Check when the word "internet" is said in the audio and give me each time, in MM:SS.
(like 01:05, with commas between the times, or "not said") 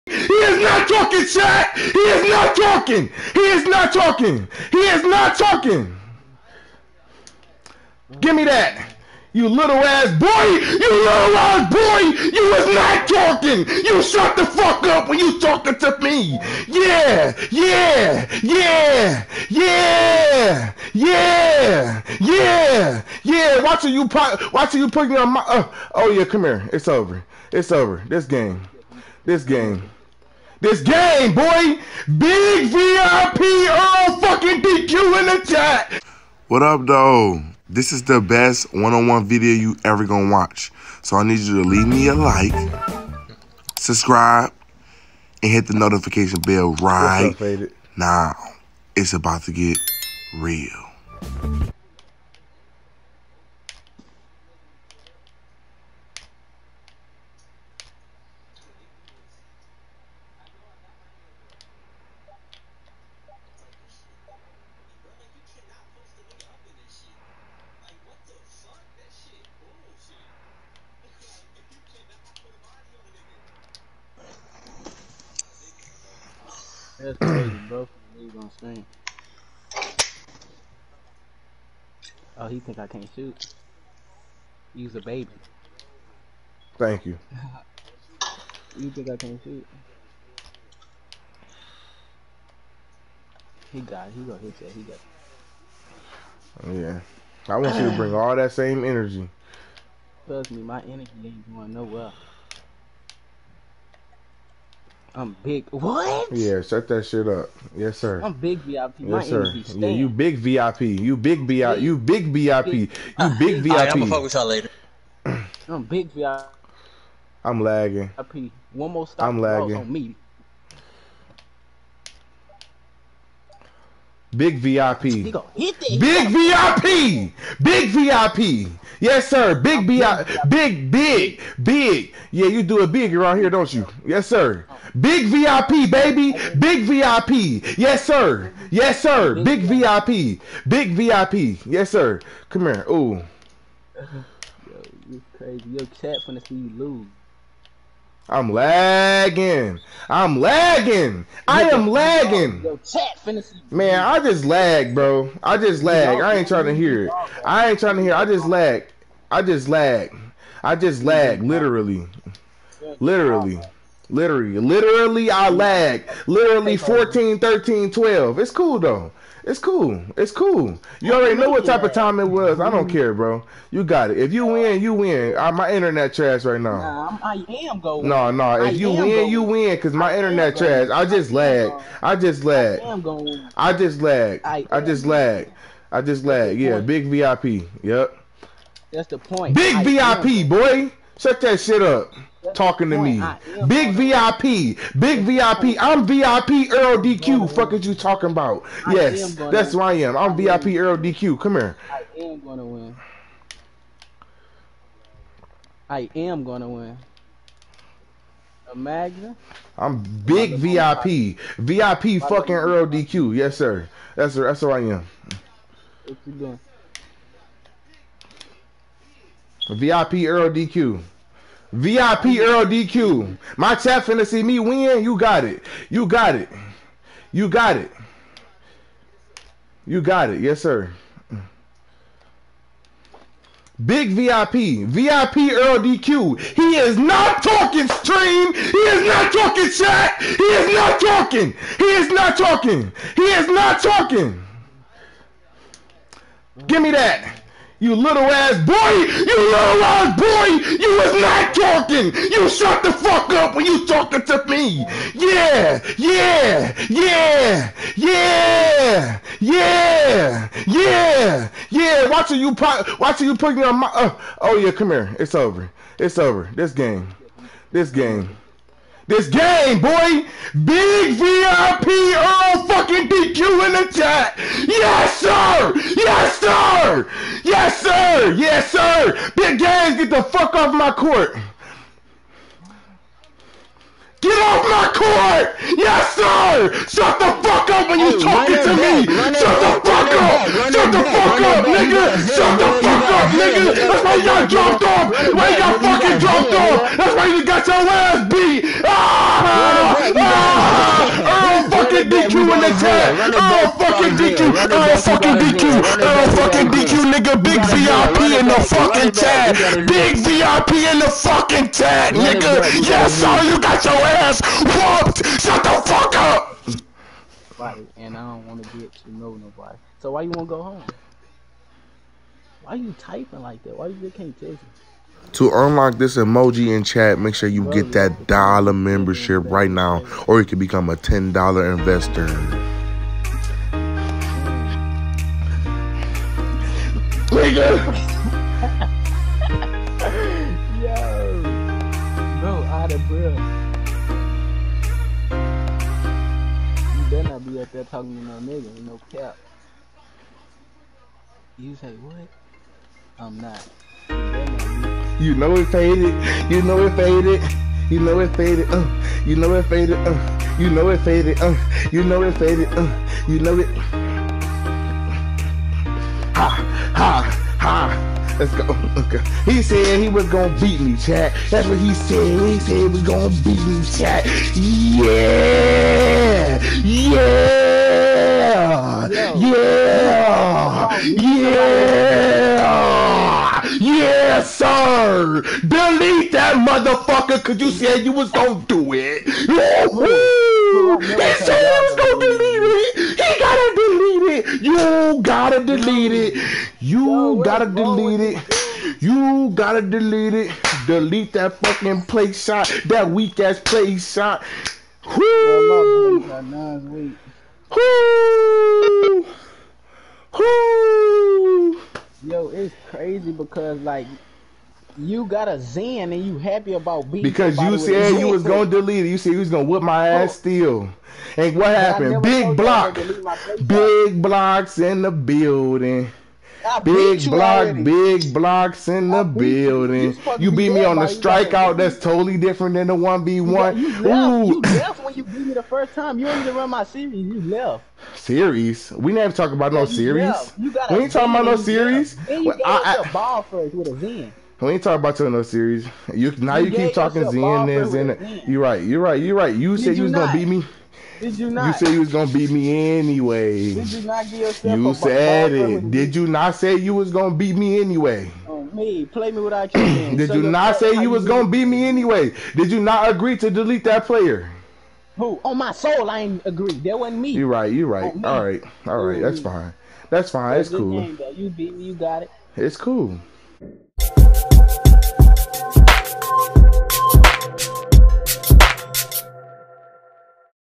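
02:55, 03:00.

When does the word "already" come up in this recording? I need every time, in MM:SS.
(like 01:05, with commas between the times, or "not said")
02:51, 07:07.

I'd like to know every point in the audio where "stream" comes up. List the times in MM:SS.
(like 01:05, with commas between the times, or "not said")
01:18, 03:57.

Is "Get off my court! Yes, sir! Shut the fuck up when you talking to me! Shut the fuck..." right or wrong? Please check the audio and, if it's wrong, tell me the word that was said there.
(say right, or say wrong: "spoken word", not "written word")
right.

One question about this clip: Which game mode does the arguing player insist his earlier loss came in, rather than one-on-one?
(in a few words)
strikeout.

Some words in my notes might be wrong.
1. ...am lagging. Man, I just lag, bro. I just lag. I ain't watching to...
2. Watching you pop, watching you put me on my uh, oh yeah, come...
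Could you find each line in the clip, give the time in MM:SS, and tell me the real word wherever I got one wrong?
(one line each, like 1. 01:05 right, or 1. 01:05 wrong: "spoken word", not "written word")
1. 02:31 wrong: "trying", not "watching"
2. 04:22 right.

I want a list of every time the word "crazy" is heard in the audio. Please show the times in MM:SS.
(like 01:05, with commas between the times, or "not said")
01:17, 02:25, 06:52.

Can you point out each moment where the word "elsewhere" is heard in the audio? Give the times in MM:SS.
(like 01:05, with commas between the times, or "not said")
not said.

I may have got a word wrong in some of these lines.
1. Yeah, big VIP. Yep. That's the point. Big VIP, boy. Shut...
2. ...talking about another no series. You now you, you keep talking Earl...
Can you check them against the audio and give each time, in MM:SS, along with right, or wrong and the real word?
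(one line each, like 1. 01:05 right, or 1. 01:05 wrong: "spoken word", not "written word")
1. 03:06 right
2. 07:24 wrong: "Zen", not "Earl".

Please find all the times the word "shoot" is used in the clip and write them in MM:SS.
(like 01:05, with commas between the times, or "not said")
01:23, 01:29.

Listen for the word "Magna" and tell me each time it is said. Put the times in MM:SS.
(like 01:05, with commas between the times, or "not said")
03:28.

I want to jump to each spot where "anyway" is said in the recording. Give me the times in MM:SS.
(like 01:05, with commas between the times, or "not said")
07:32, 07:37, 07:41.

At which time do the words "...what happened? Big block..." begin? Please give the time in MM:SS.
07:01.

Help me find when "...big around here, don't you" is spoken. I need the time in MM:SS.
02:12.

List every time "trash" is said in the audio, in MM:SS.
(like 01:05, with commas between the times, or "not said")
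02:56, 03:00.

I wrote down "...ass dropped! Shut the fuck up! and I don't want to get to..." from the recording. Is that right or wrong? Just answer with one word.
wrong.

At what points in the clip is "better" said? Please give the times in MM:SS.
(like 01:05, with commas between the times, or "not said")
05:47.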